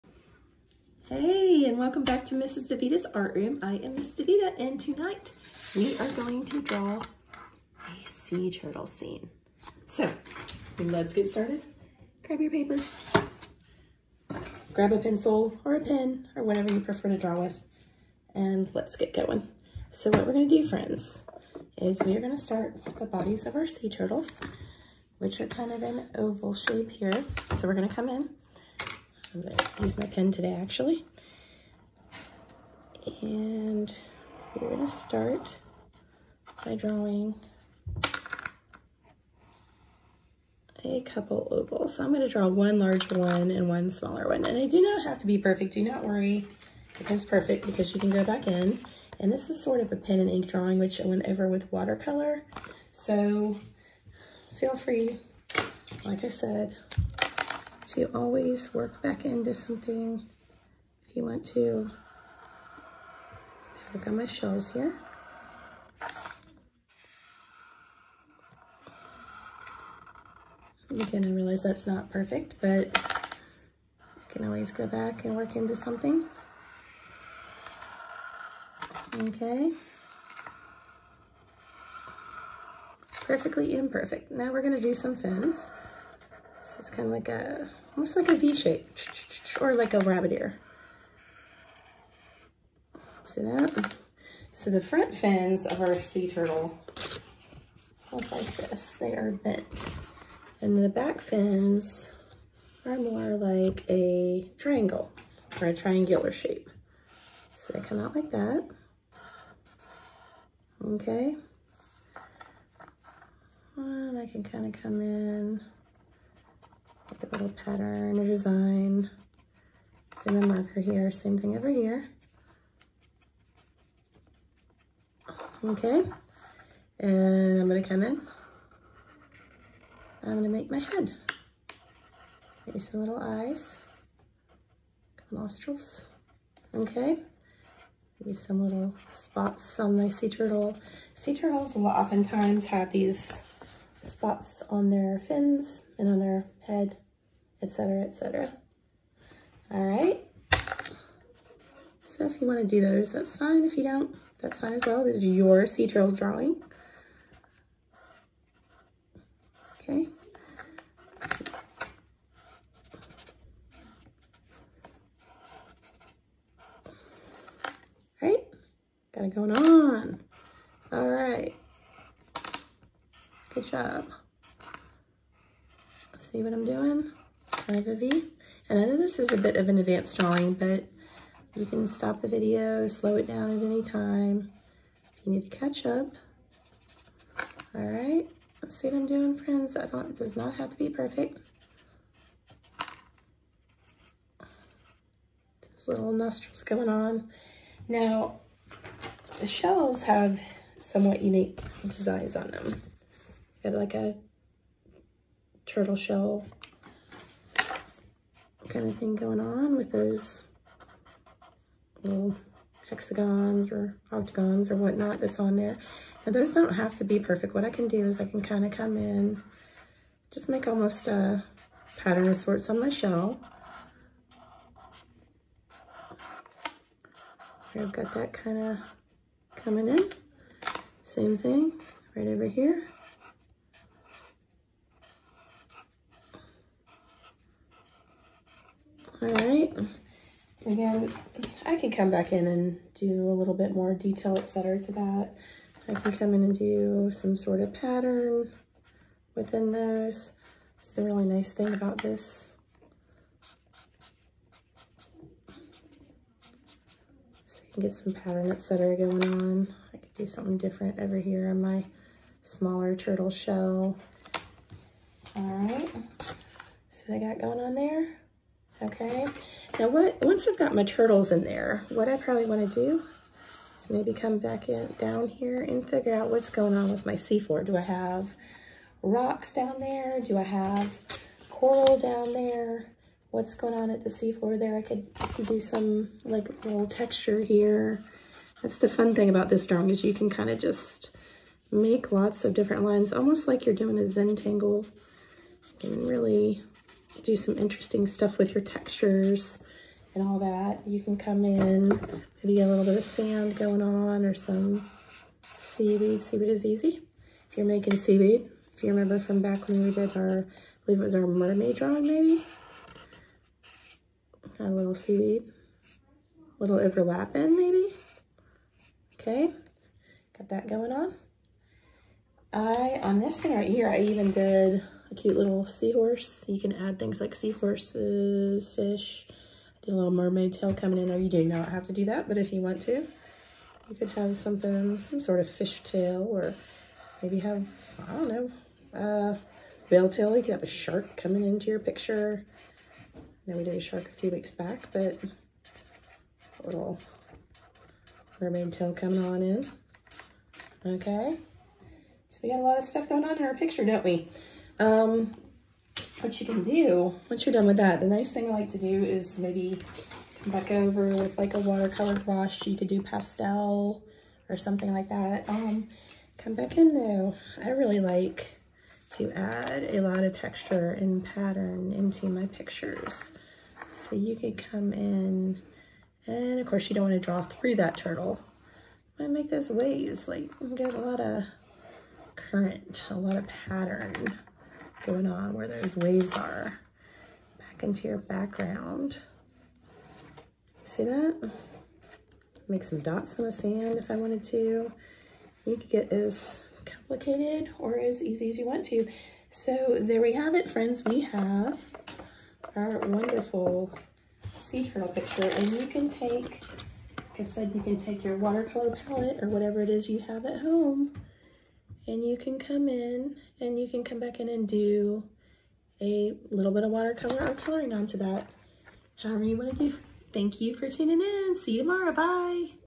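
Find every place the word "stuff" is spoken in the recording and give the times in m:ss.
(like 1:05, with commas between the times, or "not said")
4:58, 5:52.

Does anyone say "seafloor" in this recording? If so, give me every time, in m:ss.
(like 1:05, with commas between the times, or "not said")
4:37, 4:44.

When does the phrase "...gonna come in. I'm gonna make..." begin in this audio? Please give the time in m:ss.
2:07.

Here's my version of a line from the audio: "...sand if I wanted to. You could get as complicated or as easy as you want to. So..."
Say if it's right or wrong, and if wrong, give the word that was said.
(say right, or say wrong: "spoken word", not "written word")
right.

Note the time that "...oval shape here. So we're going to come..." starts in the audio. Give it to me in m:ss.
0:26.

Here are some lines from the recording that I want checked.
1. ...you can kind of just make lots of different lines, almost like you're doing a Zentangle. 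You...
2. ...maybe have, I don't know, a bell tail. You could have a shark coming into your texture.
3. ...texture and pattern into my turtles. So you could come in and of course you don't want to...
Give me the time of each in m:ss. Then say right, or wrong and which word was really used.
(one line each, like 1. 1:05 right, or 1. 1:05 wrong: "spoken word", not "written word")
1. 4:50 right
2. 5:37 wrong: "picture", not "texture"
3. 6:10 wrong: "pictures", not "turtles".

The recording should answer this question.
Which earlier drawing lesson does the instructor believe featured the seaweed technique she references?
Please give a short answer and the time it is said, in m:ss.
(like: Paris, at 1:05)
Mermaid drawing, at 5:11.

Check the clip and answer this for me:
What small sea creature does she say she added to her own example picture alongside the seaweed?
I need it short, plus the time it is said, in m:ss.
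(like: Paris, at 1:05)
Seahorse, at 5:25.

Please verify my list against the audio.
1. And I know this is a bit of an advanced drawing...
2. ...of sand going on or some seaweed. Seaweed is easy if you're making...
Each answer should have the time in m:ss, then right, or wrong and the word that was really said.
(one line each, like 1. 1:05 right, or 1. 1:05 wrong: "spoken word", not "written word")
1. 2:58 right
2. 5:02 right.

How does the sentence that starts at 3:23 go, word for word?
Got like a turtle shell kind of thing going on with those little hexagons or octagons or whatnot that's on there.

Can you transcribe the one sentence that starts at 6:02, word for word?
You could do pastel or something like that.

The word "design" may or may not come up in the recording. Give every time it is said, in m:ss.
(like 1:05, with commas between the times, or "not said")
1:58, 3:21.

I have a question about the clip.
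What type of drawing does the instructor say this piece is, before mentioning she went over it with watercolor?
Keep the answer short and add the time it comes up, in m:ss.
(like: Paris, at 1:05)
Pen and ink drawing, at 0:49.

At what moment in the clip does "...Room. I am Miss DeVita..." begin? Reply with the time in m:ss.
0:03.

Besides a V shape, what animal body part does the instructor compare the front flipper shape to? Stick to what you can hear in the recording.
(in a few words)
Rabbit ear.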